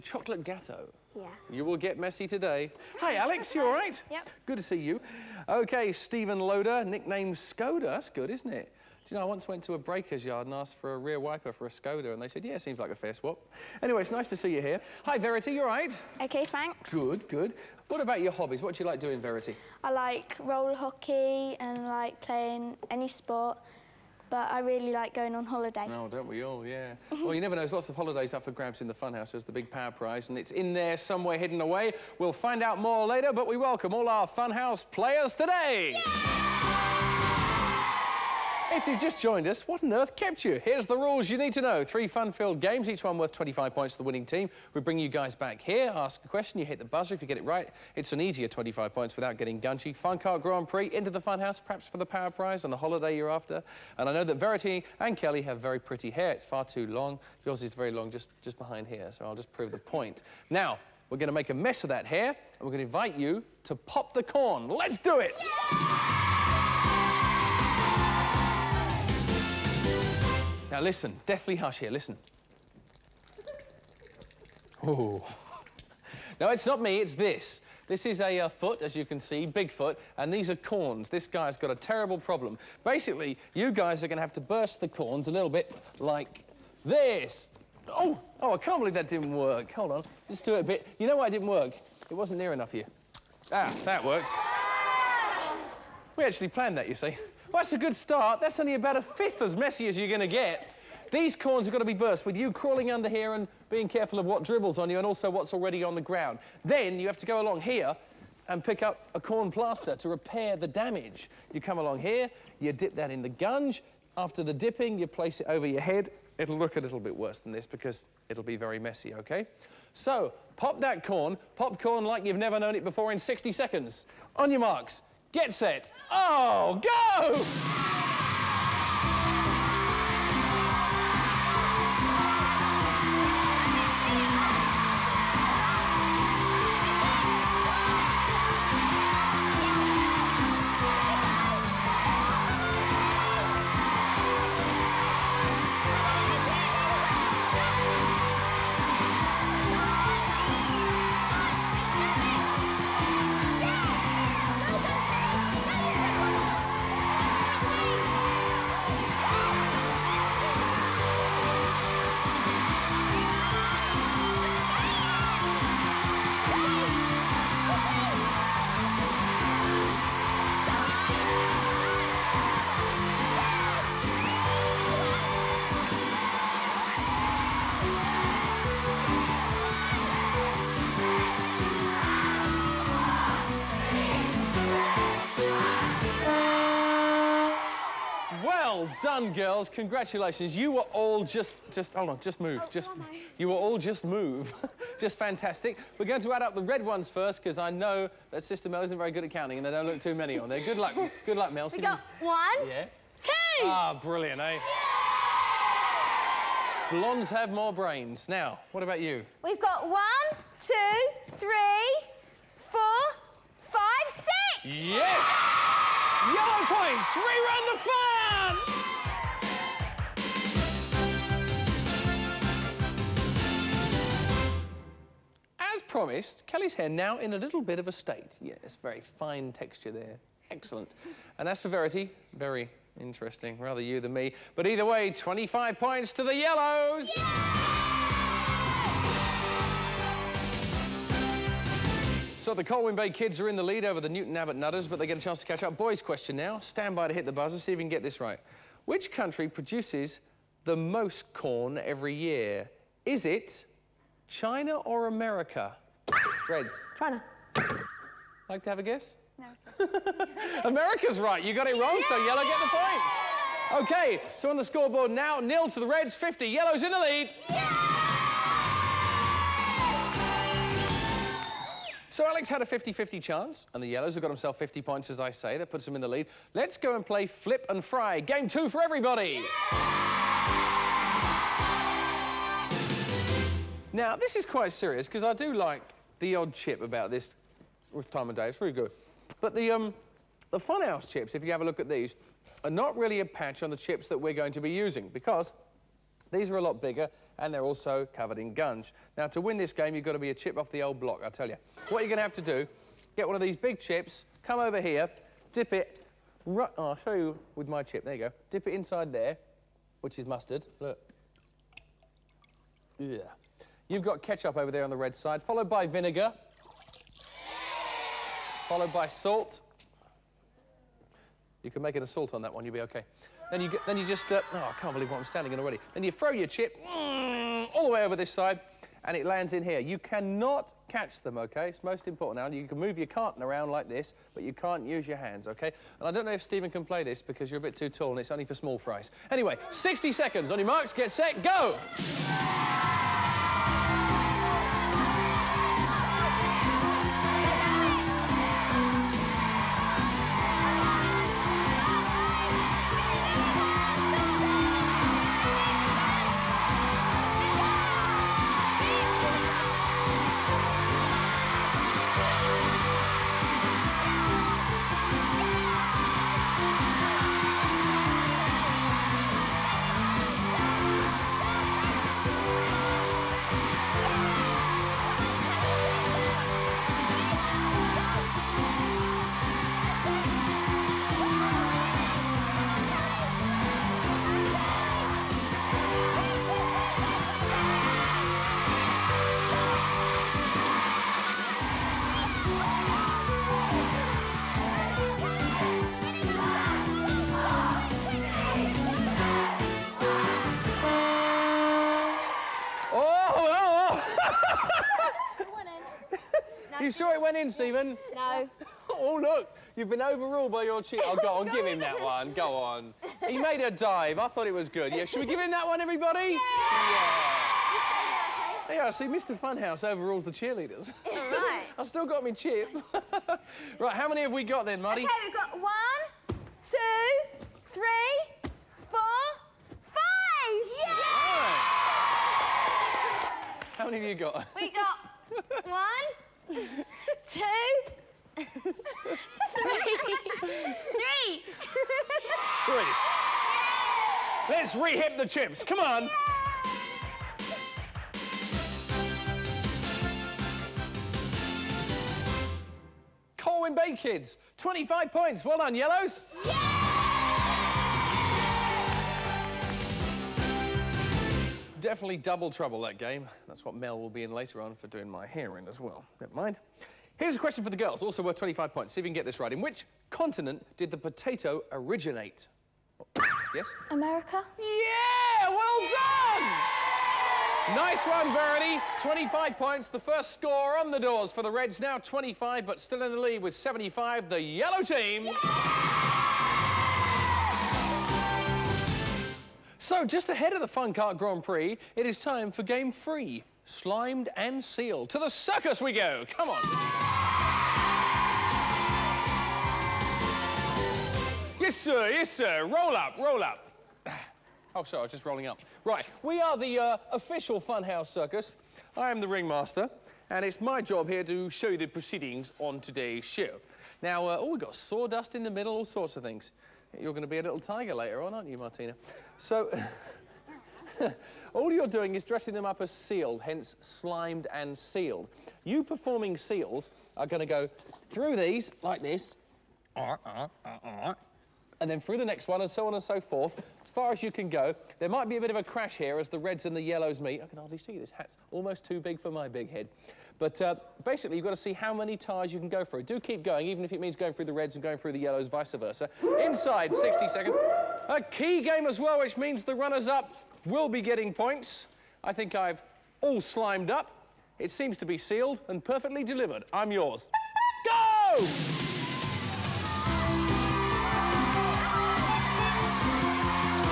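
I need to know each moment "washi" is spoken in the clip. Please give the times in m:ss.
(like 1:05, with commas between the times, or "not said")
not said.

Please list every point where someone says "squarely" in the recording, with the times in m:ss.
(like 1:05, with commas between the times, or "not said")
not said.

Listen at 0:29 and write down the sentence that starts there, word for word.
There's the big power prize, and it's in there somewhere hidden away.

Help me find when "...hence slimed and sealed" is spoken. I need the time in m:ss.
8:43.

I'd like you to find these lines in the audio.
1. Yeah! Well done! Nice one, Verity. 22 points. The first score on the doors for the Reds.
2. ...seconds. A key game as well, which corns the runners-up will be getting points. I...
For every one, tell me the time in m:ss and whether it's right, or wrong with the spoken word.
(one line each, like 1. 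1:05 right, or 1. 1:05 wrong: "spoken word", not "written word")
1. 7:54 wrong: "25", not "22"
2. 9:07 wrong: "means", not "corns".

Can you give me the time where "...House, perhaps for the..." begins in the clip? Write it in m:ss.
0:51.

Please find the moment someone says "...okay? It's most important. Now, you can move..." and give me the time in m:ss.
5:31.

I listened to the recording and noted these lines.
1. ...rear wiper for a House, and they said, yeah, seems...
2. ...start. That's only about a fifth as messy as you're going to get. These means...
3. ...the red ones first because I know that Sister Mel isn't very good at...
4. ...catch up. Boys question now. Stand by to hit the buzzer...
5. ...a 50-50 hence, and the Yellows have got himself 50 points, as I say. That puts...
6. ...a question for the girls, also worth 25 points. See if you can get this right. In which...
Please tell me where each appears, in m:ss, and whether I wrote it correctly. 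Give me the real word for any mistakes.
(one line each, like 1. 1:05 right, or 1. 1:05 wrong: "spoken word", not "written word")
1. 0:10 wrong: "Skoda", not "House"
2. 1:37 wrong: "corns", not "means"
3. 3:16 right
4. 4:05 right
5. 4:32 wrong: "chance", not "hence"
6. 7:47 right.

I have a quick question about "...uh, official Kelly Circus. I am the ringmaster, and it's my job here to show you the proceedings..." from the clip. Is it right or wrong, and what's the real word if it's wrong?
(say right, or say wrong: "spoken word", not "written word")
wrong: "Funhouse", not "Kelly".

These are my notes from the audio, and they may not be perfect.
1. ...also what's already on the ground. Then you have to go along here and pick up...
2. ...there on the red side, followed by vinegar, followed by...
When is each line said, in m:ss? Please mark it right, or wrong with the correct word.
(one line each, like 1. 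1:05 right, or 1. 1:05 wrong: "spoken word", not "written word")
1. 1:45 right
2. 5:14 right.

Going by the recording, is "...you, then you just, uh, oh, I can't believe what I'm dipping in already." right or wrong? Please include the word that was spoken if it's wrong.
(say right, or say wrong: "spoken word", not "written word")
wrong: "standing", not "dipping".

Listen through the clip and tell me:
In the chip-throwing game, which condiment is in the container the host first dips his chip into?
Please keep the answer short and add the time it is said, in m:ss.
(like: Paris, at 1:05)
Mustard, at 5:10.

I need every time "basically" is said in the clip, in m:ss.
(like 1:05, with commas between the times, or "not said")
1:22, 9:01.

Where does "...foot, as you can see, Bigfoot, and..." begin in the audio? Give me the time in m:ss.
1:18.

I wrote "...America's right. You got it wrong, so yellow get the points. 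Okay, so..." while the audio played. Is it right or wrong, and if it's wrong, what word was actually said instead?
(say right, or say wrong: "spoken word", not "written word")
right.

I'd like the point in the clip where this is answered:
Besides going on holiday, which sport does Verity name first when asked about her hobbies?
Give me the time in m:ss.
0:20.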